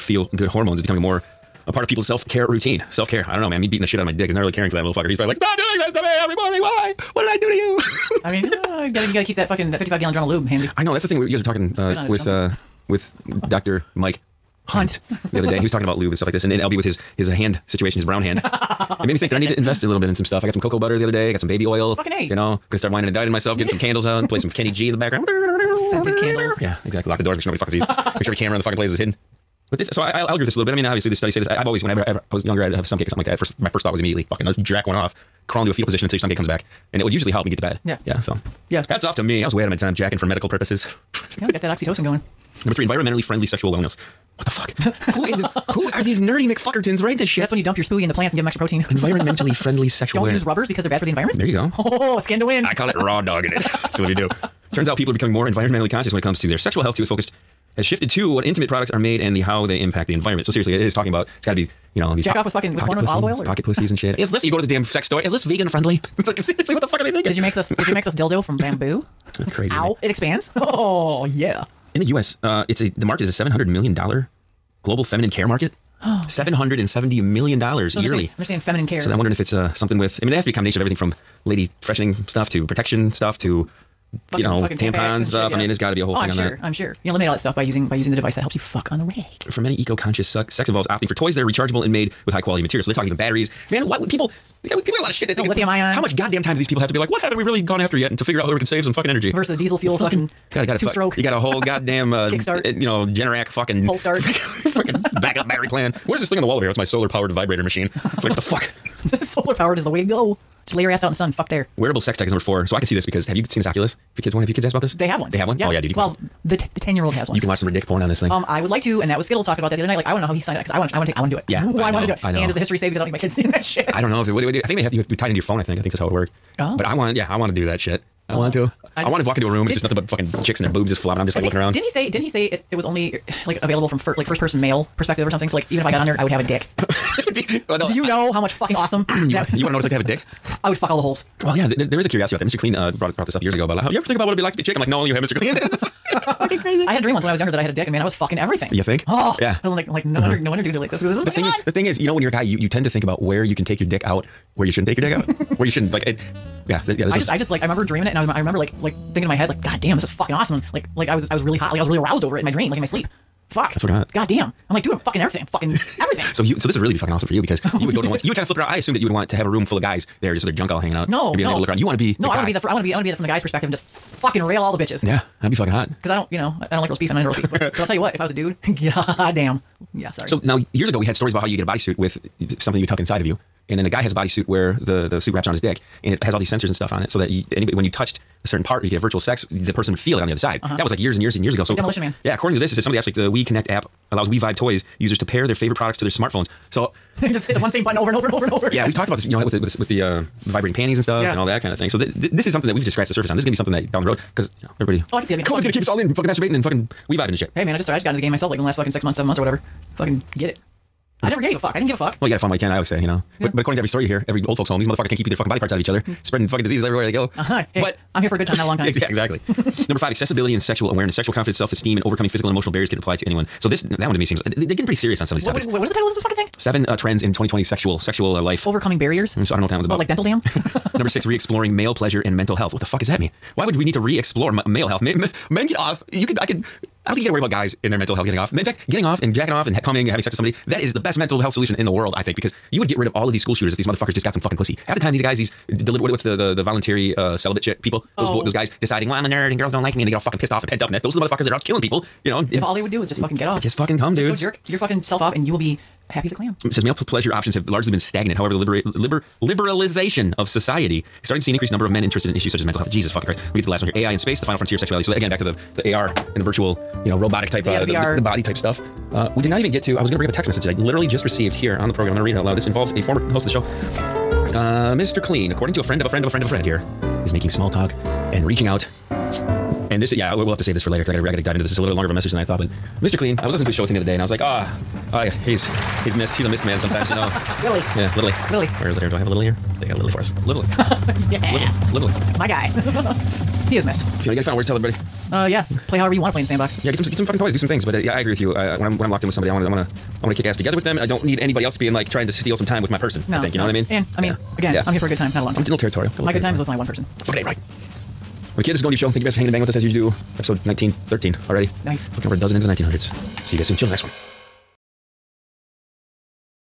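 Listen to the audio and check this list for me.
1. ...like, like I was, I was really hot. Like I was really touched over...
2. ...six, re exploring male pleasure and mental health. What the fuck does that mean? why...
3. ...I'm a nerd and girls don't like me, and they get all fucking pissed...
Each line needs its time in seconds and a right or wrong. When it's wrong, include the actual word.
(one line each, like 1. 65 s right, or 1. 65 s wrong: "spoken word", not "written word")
1. 160 s wrong: "aroused", not "touched"
2. 231 s right
3. 249 s right.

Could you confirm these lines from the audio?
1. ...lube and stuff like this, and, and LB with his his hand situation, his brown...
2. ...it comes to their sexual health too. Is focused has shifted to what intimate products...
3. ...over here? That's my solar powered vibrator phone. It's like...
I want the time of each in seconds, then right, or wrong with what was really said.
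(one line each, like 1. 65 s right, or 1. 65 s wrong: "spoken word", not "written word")
1. 15 s right
2. 56 s right
3. 106 s wrong: "machine", not "phone".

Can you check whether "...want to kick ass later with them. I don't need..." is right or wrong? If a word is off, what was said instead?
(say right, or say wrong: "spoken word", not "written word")
wrong: "together", not "later".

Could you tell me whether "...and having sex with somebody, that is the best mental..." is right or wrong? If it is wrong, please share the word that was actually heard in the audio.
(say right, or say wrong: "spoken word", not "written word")
right.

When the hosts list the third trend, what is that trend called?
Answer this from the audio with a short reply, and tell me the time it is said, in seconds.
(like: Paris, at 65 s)
Environmentally friendly sexual wellness, at 42 s.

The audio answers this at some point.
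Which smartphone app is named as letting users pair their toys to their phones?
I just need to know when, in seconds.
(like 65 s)
193 s.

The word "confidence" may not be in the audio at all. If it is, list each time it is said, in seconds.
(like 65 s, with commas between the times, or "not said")
221 s.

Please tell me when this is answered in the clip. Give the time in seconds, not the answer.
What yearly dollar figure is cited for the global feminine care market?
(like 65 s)
76 s.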